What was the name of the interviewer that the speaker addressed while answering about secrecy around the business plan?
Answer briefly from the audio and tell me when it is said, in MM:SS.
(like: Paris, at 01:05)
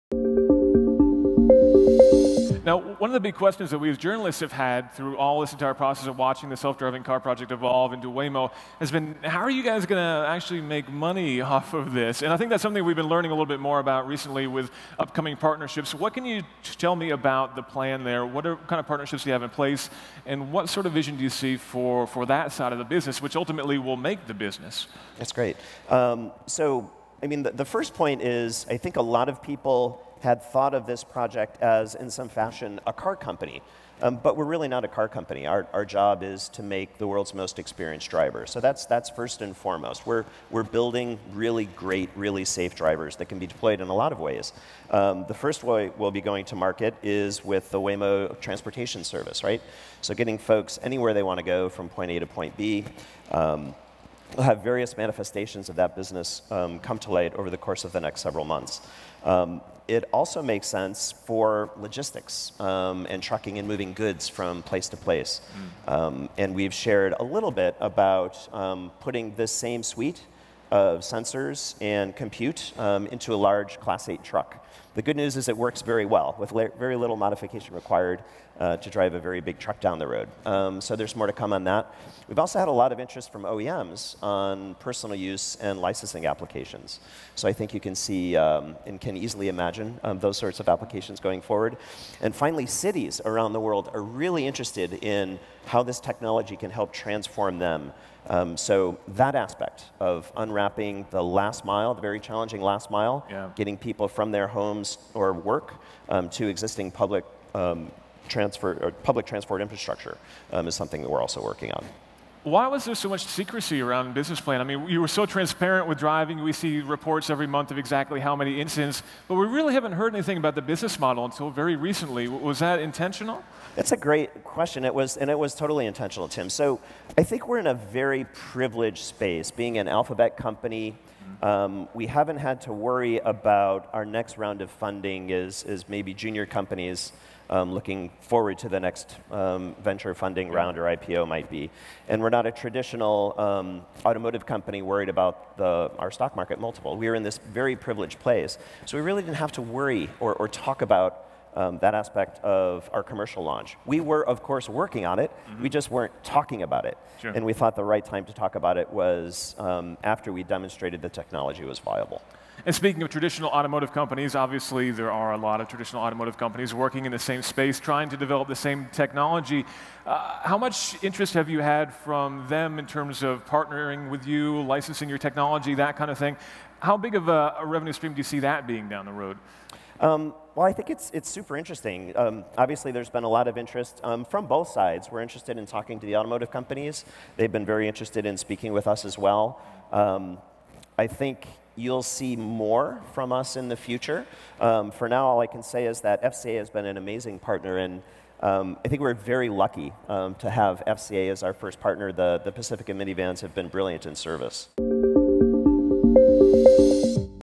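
Tim, at 02:06.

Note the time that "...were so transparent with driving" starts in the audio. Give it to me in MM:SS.
01:54.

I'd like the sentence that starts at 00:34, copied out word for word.
Um, but we're really not a car company.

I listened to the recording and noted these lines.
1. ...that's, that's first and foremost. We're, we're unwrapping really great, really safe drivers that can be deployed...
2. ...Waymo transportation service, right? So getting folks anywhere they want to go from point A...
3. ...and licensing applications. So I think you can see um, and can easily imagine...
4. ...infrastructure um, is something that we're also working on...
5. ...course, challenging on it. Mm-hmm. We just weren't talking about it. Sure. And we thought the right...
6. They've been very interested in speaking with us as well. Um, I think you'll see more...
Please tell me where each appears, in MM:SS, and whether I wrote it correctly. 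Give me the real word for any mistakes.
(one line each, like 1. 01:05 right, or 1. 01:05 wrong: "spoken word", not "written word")
1. 00:38 wrong: "building", not "unwrapping"
2. 00:47 right
3. 01:25 right
4. 01:49 right
5. 02:34 wrong: "working", not "challenging"
6. 03:07 right.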